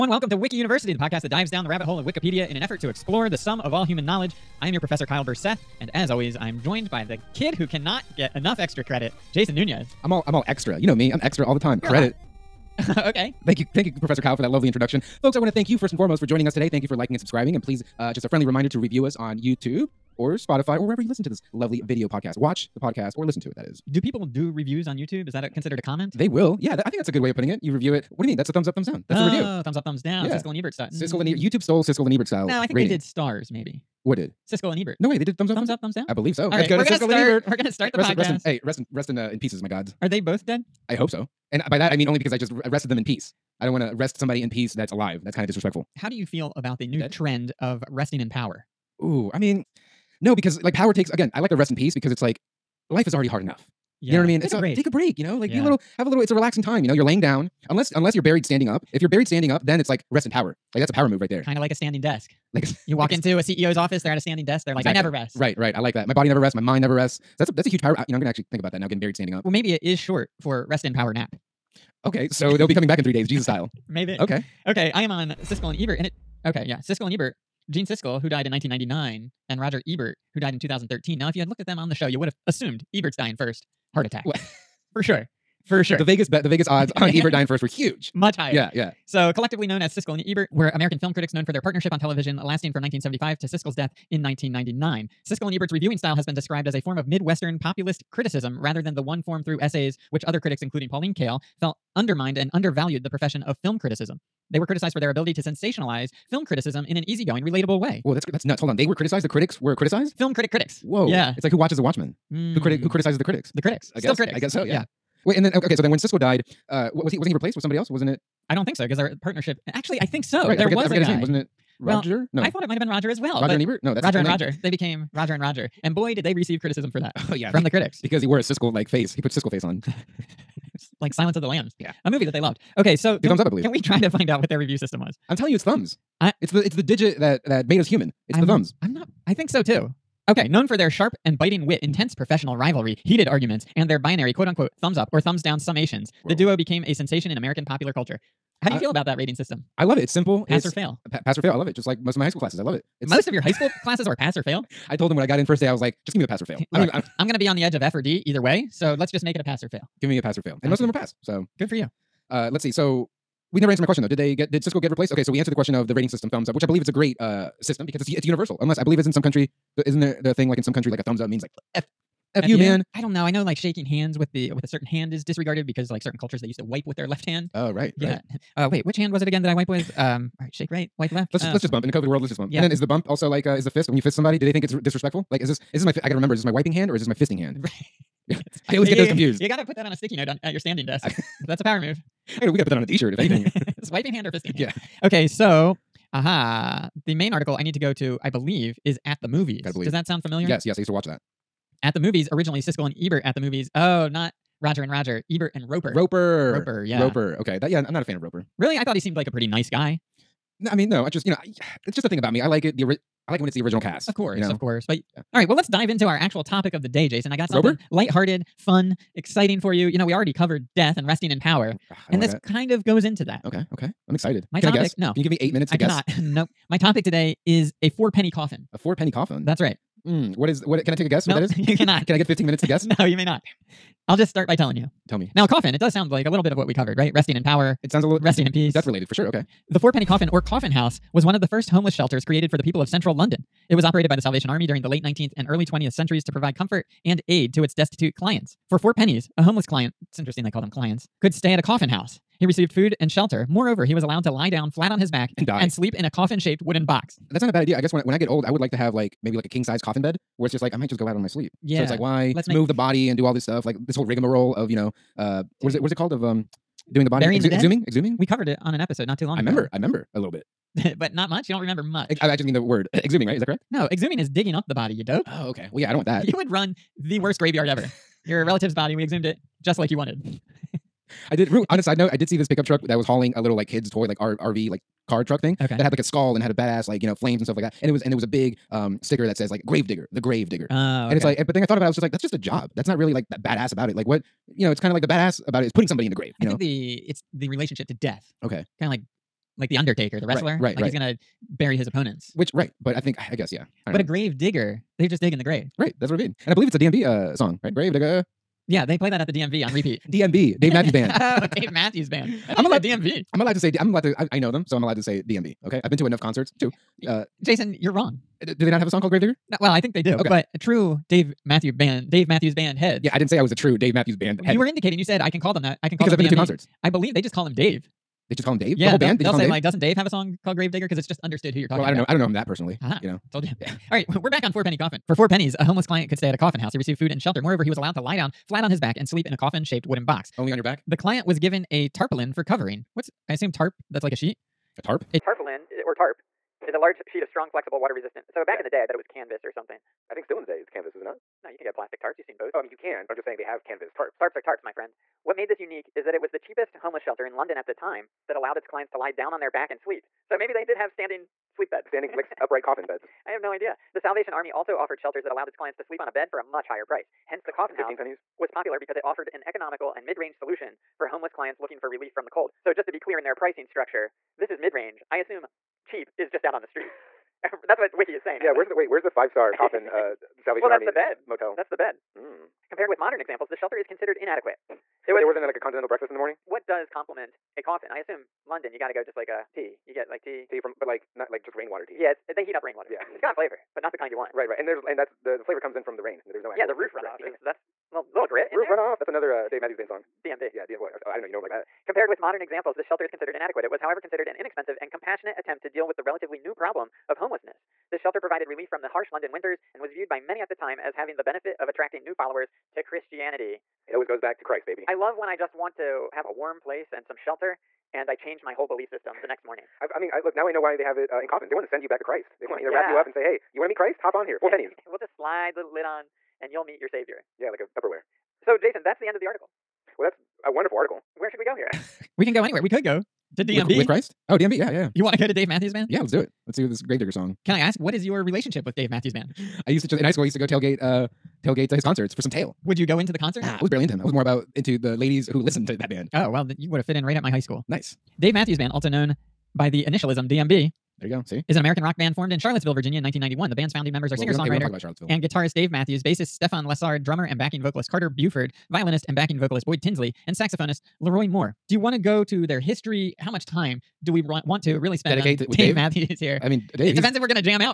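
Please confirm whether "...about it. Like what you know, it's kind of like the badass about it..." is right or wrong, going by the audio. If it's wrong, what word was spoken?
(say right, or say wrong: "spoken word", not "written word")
right.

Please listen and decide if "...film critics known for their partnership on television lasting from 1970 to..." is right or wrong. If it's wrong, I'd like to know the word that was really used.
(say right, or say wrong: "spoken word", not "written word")
wrong: "1975", not "1970".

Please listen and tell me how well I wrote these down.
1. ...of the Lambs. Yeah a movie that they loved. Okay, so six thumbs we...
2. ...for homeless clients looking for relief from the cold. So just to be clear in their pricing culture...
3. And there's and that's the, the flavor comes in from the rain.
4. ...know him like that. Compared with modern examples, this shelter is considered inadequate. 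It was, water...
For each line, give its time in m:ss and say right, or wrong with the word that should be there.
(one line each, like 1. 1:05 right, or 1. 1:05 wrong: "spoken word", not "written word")
1. 2:11 wrong: "two", not "six"
2. 6:10 wrong: "structure", not "culture"
3. 6:34 right
4. 6:41 wrong: "however", not "water".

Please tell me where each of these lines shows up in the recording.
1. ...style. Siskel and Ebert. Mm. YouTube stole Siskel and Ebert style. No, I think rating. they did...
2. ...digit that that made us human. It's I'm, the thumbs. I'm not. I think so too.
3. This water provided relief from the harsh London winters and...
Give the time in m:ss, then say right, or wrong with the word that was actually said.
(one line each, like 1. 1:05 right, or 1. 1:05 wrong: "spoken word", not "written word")
1. 0:30 right
2. 2:16 right
3. 6:47 wrong: "shelter", not "water".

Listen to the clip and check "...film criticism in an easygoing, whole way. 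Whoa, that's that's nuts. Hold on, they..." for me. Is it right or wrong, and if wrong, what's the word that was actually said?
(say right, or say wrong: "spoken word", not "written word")
wrong: "relatable", not "whole".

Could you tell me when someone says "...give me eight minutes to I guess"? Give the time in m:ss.
3:45.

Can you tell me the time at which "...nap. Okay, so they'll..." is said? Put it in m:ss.
1:11.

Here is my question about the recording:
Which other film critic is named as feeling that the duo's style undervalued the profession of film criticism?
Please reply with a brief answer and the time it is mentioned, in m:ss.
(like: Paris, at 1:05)
Pauline Kael, at 1:40.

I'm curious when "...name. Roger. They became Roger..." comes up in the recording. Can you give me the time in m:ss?
2:04.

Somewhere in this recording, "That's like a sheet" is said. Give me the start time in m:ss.
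5:43.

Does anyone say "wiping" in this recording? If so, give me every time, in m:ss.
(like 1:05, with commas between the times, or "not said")
3:06, 3:13.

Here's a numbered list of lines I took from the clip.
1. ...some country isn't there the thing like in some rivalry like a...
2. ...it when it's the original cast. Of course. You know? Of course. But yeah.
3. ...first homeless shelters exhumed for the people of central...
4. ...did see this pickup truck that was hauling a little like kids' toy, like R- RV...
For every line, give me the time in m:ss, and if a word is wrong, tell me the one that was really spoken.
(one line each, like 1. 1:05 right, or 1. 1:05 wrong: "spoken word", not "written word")
1. 2:49 wrong: "country", not "rivalry"
2. 3:33 right
3. 4:01 wrong: "created", not "exhumed"
4. 4:42 right.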